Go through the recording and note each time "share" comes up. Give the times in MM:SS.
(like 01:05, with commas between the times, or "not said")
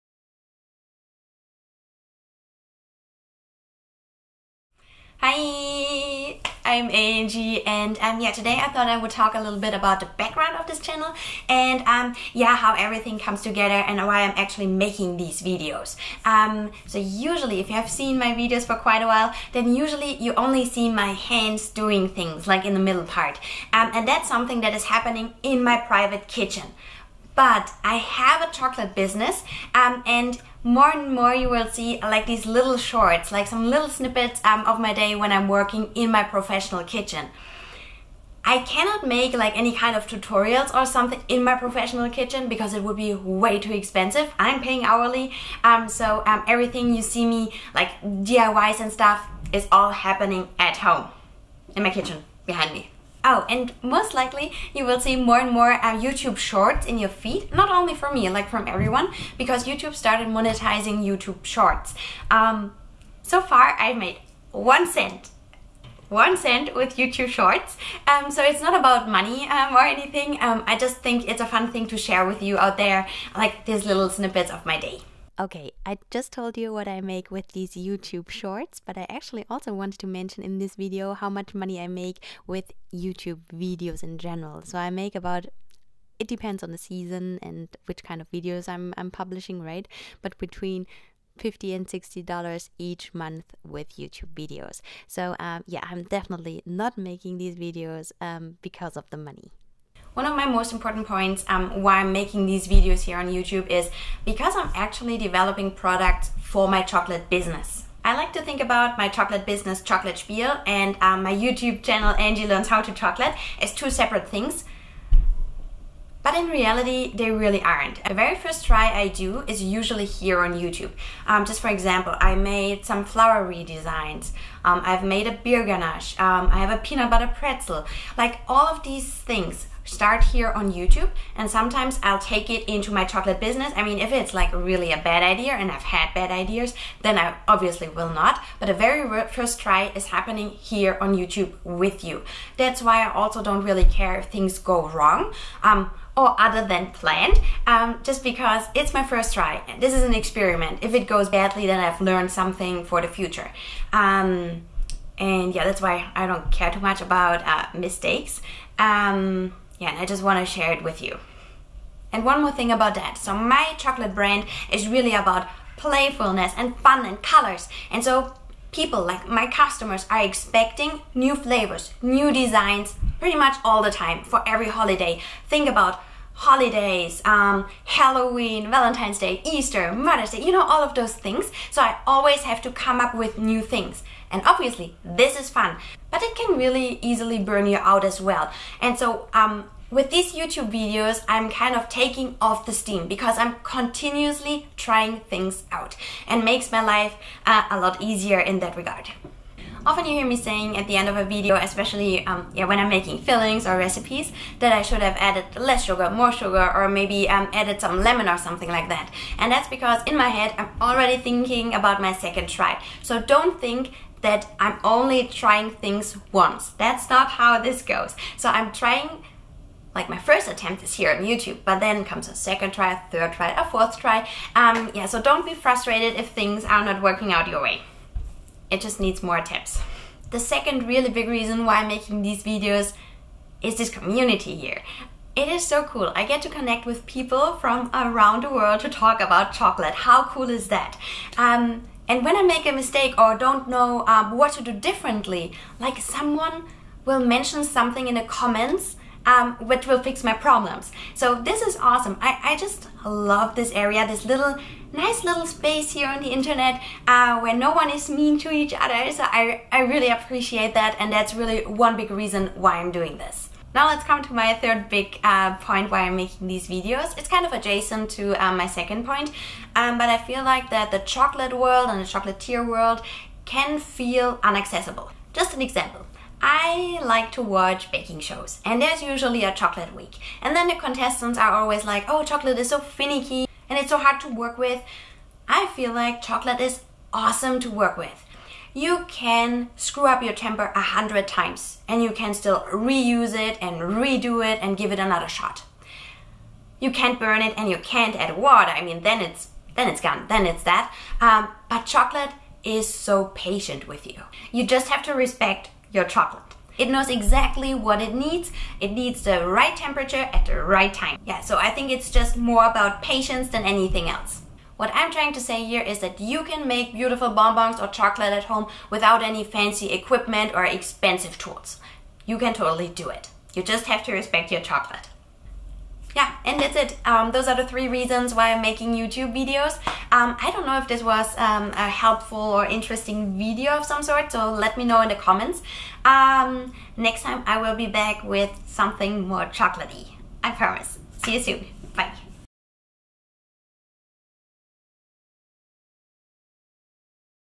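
01:11, 02:40.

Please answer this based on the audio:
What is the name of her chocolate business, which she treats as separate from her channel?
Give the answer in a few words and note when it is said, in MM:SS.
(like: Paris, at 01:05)
Chocolate Spiel, at 01:49.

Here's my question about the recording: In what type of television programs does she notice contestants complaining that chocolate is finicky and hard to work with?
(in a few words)
Baking shows.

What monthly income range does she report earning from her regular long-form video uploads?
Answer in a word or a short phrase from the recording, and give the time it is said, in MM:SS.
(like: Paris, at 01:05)
$50 to $60, at 01:30.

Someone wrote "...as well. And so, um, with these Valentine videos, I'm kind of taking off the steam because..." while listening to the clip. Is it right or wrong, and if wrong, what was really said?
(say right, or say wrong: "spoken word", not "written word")
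wrong: "YouTube", not "Valentine".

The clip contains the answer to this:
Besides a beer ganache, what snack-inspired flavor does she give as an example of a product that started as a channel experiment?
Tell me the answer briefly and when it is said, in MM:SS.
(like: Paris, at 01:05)
Peanut butter pretzel, at 02:06.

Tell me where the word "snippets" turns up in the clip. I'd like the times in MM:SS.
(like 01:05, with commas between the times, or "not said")
00:33, 01:14.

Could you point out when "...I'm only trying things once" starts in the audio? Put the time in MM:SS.
03:34.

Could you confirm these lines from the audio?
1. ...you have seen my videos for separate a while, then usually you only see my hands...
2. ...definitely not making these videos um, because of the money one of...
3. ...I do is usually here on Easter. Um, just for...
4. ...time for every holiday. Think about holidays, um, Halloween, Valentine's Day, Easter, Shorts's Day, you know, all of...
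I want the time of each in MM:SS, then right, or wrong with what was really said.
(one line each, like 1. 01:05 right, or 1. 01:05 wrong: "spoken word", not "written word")
1. 00:17 wrong: "quite", not "separate"
2. 01:36 right
3. 01:58 wrong: "YouTube", not "Easter"
4. 02:53 wrong: "Mother", not "Shorts".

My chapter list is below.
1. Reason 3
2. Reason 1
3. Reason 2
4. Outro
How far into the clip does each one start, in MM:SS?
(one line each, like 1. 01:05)
1. 04:23
2. 01:42
3. 03:50
4. 05:26.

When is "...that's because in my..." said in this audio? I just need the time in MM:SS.
03:29.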